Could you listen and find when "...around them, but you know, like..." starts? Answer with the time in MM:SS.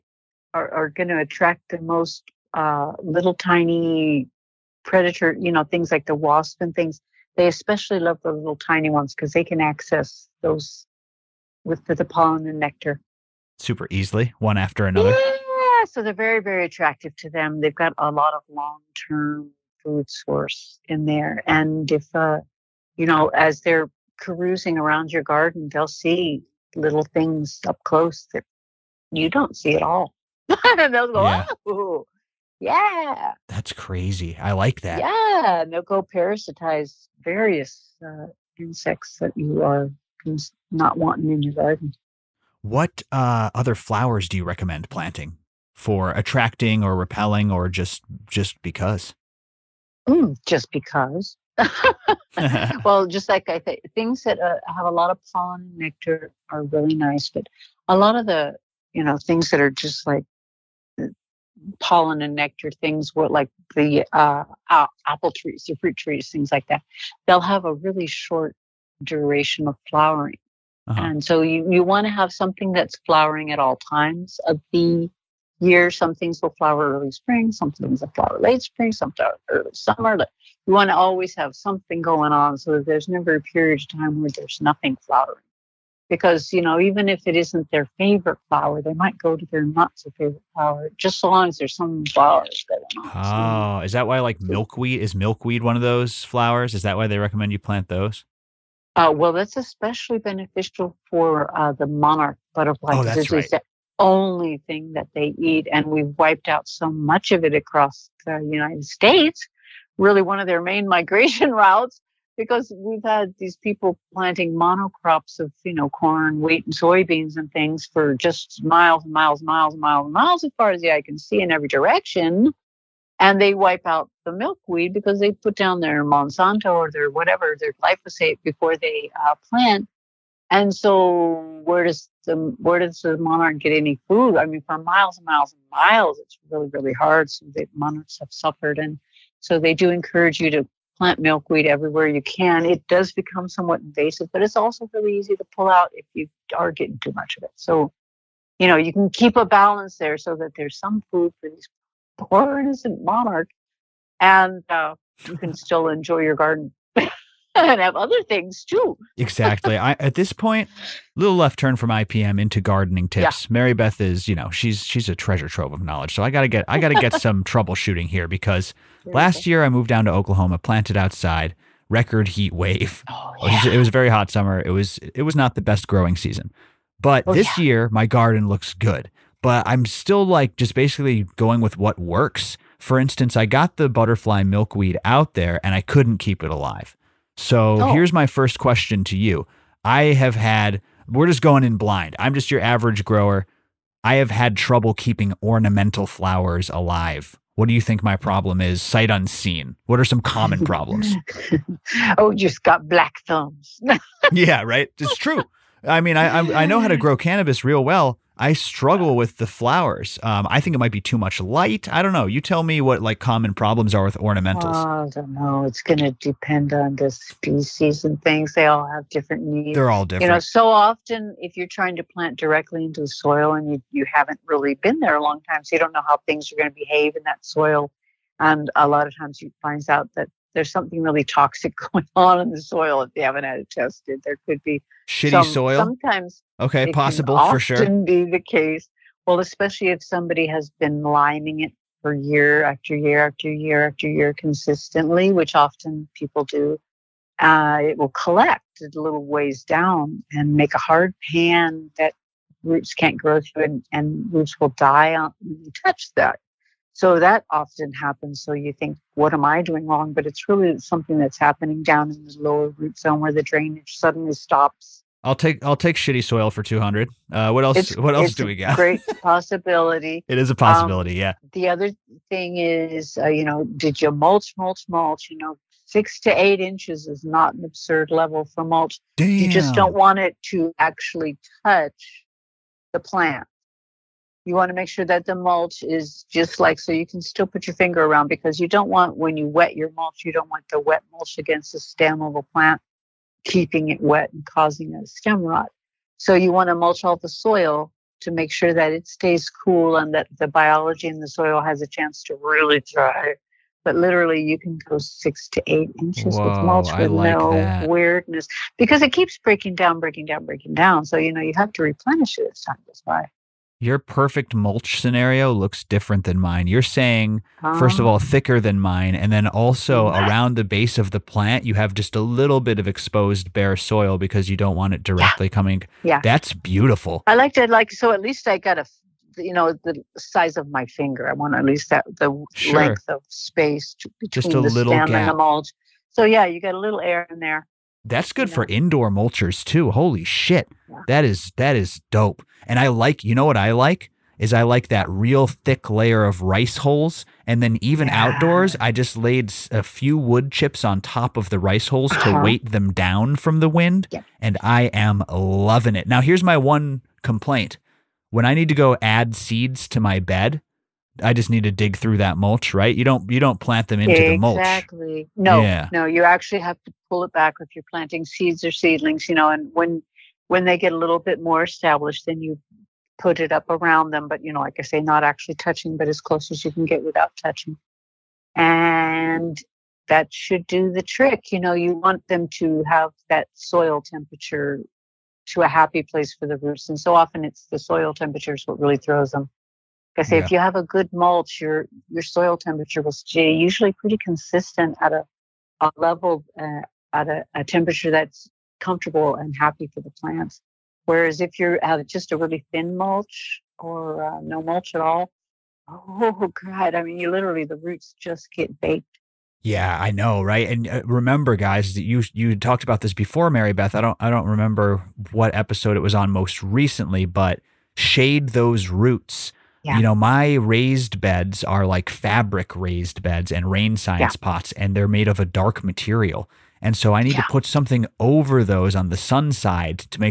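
06:13.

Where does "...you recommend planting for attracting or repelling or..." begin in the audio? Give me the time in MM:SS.
00:44.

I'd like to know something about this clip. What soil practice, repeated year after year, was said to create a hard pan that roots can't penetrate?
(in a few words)
Liming.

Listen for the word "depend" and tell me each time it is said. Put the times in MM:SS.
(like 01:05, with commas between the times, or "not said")
03:36.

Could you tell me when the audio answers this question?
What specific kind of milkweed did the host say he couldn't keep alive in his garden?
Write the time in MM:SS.
03:03.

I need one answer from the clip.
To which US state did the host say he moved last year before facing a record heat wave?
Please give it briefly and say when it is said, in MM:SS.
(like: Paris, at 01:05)
Oklahoma, at 02:50.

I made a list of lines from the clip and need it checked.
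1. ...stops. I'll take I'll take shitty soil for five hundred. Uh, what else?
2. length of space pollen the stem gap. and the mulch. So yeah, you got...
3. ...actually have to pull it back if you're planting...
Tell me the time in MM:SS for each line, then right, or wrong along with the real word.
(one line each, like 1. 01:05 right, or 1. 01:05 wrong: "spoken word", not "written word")
1. 04:24 wrong: "two", not "five"
2. 05:32 wrong: "between", not "pollen"
3. 06:06 right.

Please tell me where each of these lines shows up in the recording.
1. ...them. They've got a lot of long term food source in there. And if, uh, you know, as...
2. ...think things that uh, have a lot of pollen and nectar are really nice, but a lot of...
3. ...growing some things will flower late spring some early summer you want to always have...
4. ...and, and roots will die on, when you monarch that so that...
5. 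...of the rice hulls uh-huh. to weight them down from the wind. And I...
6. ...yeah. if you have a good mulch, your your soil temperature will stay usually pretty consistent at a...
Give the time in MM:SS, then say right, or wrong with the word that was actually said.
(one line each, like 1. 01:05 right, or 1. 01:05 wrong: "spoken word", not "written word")
1. 00:17 right
2. 00:53 right
3. 01:17 wrong: "spring", not "growing"
4. 04:13 wrong: "touch", not "monarch"
5. 05:51 right
6. 06:30 right.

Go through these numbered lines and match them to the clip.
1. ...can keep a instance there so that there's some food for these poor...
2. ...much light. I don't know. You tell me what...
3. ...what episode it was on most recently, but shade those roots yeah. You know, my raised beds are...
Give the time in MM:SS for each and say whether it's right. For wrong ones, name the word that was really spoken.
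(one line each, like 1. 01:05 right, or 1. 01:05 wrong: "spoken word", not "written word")
1. 02:28 wrong: "balance", not "instance"
2. 03:31 right
3. 06:55 right.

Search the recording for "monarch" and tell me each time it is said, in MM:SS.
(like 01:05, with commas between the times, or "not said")
01:41, 02:13, 02:17, 02:33.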